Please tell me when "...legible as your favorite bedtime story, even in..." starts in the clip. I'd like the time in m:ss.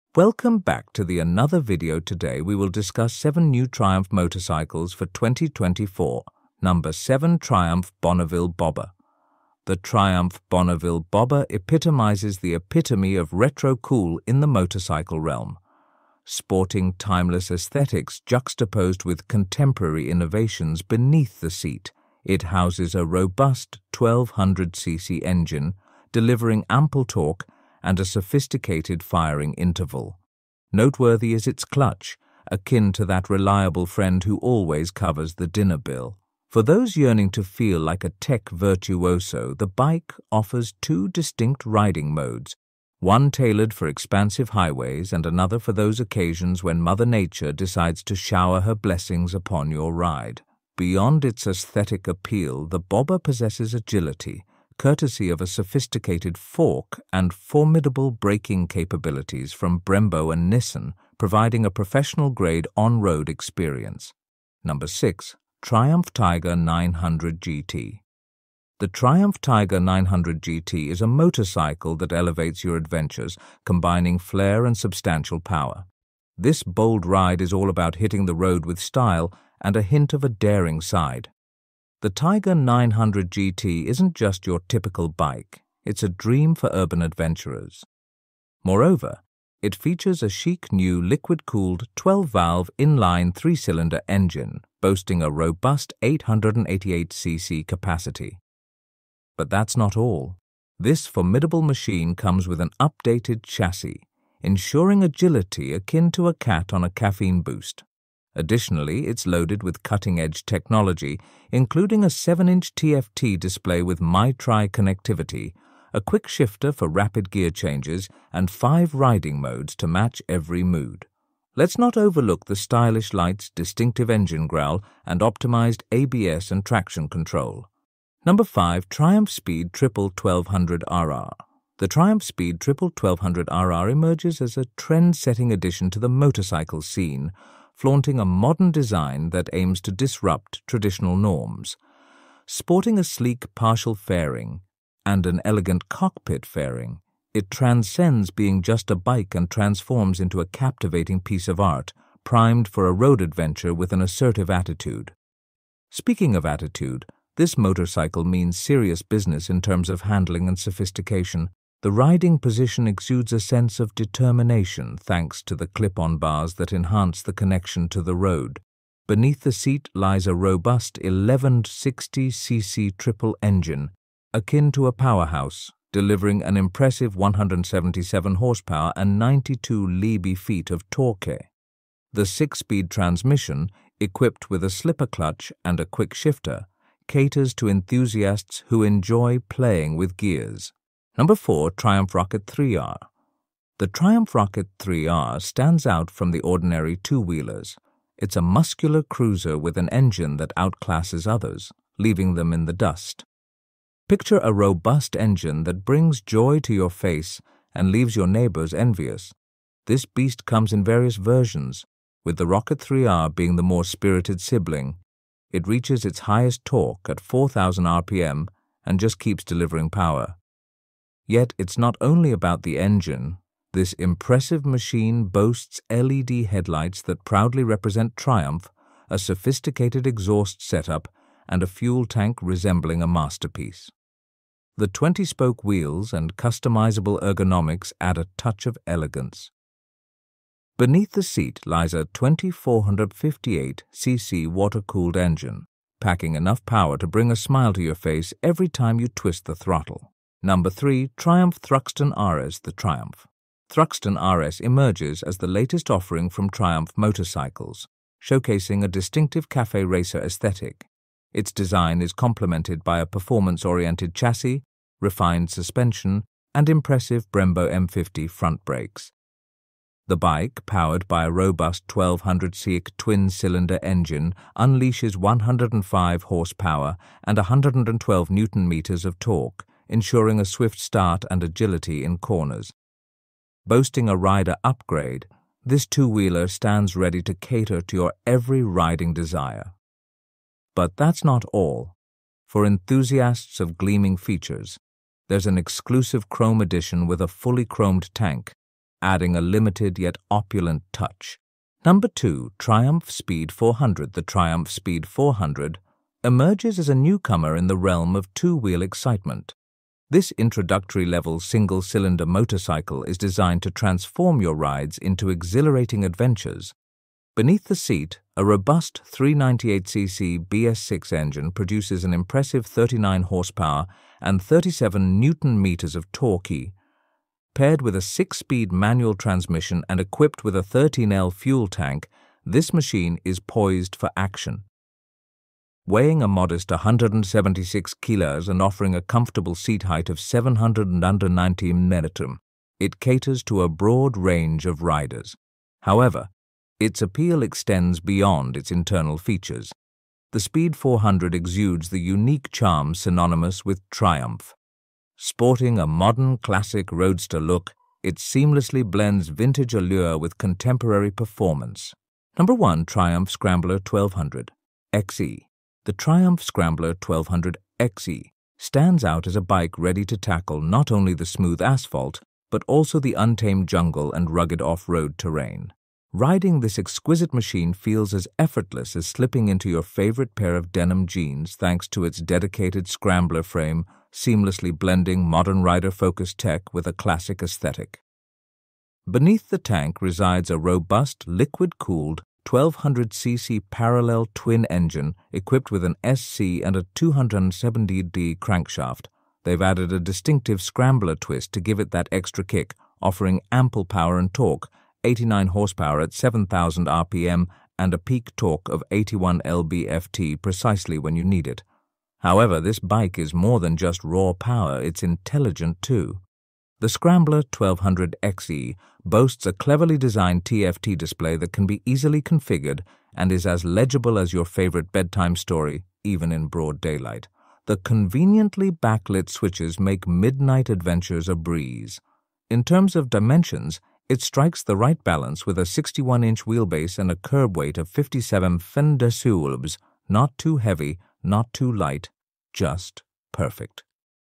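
7:03.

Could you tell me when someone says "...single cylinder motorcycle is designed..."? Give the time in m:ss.
5:11.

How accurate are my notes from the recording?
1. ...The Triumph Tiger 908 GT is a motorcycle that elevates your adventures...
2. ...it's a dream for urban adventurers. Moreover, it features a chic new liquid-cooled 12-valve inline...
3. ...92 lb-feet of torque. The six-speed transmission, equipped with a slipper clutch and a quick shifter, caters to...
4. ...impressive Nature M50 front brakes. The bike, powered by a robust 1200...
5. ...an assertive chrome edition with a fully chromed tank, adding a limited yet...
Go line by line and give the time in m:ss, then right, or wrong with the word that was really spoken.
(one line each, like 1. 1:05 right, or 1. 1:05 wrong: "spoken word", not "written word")
1. 1:08 wrong: "900", not "908"
2. 1:25 right
3. 2:59 right
4. 4:26 wrong: "Brembo", not "Nature"
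5. 4:55 wrong: "exclusive", not "assertive".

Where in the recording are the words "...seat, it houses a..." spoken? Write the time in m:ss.
0:21.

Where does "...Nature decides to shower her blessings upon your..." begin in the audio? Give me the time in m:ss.
0:47.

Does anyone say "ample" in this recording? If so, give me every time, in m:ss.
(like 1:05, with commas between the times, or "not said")
0:26, 6:43.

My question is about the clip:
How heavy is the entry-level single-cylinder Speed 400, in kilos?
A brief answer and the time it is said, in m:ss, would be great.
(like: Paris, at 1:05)
176 kilos, at 5:36.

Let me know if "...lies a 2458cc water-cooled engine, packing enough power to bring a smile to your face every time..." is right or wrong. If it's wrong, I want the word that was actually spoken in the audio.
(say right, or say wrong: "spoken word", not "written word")
right.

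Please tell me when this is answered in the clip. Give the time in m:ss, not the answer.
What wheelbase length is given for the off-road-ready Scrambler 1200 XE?
7:15.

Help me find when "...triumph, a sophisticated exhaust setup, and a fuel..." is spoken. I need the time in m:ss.
3:48.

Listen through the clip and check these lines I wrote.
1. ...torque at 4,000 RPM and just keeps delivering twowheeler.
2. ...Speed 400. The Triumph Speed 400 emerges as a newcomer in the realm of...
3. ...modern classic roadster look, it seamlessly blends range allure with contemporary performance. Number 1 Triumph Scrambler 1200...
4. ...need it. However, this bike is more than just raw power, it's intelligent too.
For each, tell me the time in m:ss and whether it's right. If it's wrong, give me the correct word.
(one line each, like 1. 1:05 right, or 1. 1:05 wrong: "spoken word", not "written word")
1. 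3:36 wrong: "power", not "twowheeler"
2. 5:03 right
3. 5:55 wrong: "vintage", not "range"
4. 6:51 right.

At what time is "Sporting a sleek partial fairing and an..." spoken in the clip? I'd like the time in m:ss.
2:22.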